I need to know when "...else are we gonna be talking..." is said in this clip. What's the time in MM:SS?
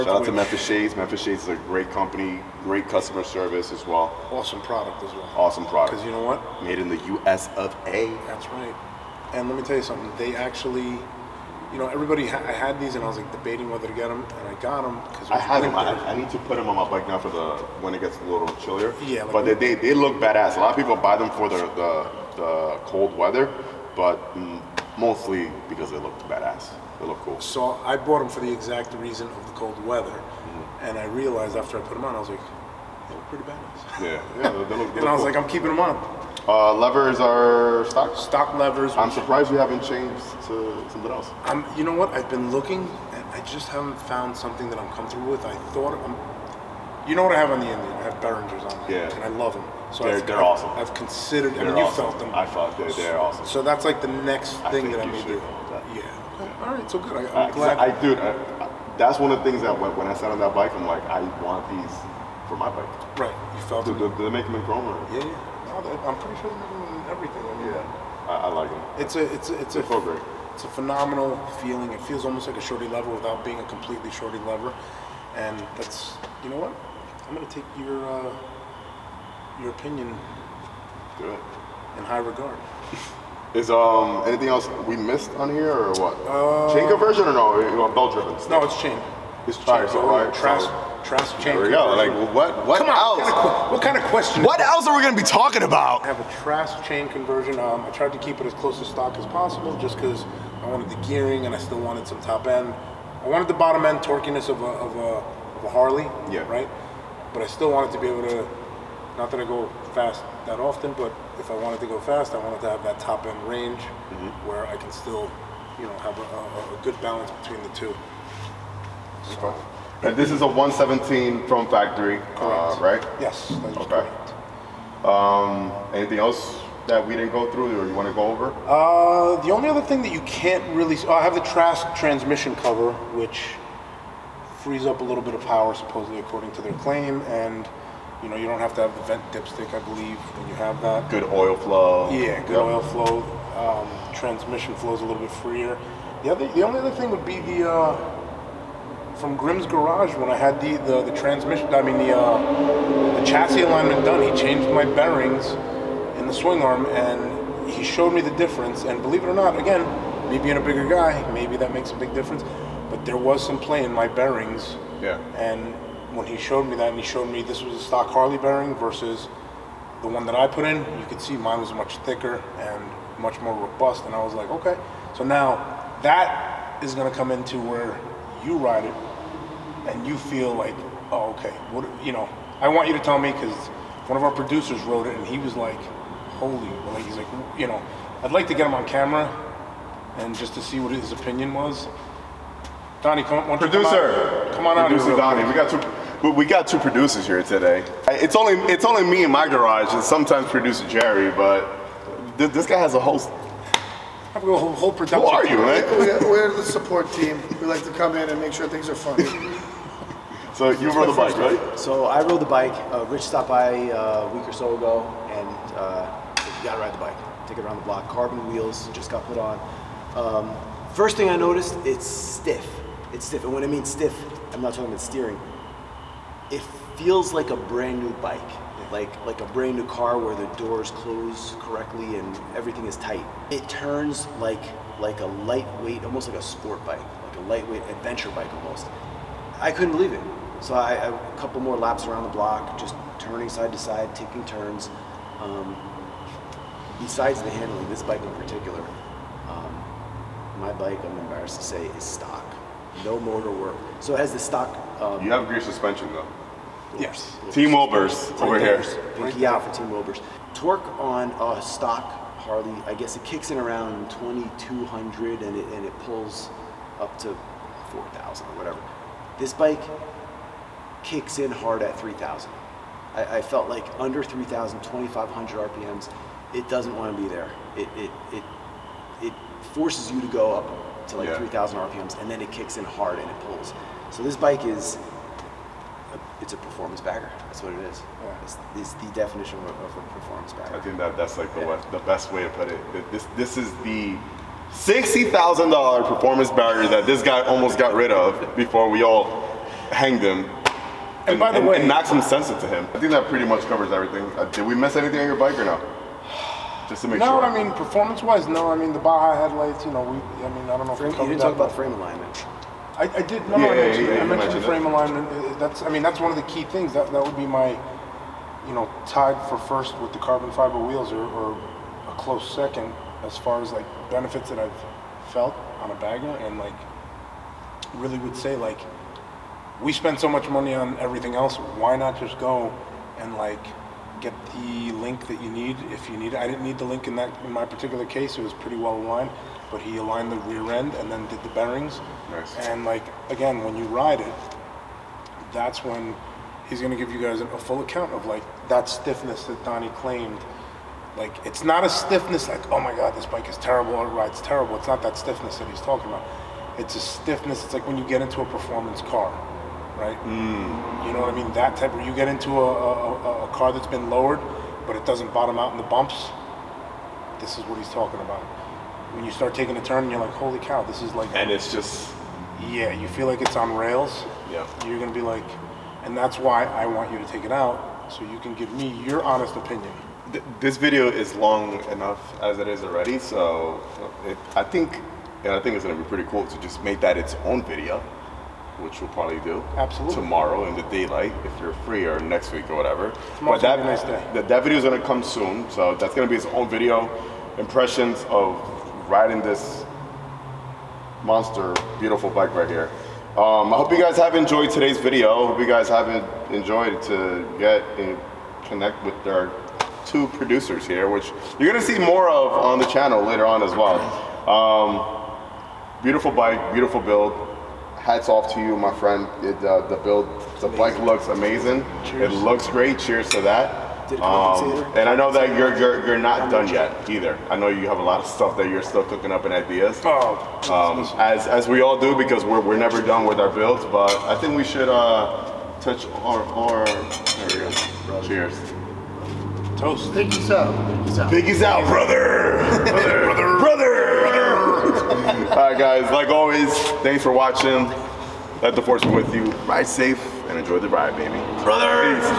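01:34.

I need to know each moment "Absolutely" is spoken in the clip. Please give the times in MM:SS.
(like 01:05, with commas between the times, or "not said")
06:29.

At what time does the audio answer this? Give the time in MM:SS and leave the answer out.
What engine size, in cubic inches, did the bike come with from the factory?
02:00.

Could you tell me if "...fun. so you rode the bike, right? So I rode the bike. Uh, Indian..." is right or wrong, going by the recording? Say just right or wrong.
wrong.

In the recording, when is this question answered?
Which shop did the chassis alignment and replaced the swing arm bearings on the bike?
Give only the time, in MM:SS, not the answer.
02:29.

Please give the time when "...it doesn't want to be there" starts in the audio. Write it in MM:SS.
04:36.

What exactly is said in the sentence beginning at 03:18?
It's only it's only me in my garage, and sometimes producer Jerry.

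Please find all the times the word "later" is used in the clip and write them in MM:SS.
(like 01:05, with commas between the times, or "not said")
06:53.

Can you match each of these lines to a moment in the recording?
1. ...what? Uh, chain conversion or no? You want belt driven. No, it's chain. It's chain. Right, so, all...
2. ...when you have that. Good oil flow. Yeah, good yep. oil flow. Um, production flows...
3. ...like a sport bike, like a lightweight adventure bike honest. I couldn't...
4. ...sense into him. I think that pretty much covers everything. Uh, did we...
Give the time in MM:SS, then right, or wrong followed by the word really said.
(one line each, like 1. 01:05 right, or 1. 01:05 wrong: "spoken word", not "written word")
1. 01:25 right
2. 02:20 wrong: "transmission", not "production"
3. 03:56 wrong: "almost", not "honest"
4. 05:02 right.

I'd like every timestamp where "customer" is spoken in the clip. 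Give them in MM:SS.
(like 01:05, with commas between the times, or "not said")
00:02.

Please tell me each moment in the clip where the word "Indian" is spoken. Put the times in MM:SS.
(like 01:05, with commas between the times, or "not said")
00:47.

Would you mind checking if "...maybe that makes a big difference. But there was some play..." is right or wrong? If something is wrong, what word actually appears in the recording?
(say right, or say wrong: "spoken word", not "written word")
right.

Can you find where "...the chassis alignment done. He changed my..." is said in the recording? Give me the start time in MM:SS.
02:33.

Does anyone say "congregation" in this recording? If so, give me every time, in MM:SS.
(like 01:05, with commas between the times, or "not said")
not said.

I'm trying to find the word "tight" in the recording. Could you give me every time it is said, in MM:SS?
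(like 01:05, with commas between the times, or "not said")
03:52.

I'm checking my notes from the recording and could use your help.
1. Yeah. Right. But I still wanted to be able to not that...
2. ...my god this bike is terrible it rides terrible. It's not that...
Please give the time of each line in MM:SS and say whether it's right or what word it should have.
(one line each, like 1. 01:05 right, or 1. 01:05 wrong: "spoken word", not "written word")
1. 01:46 right
2. 05:52 right.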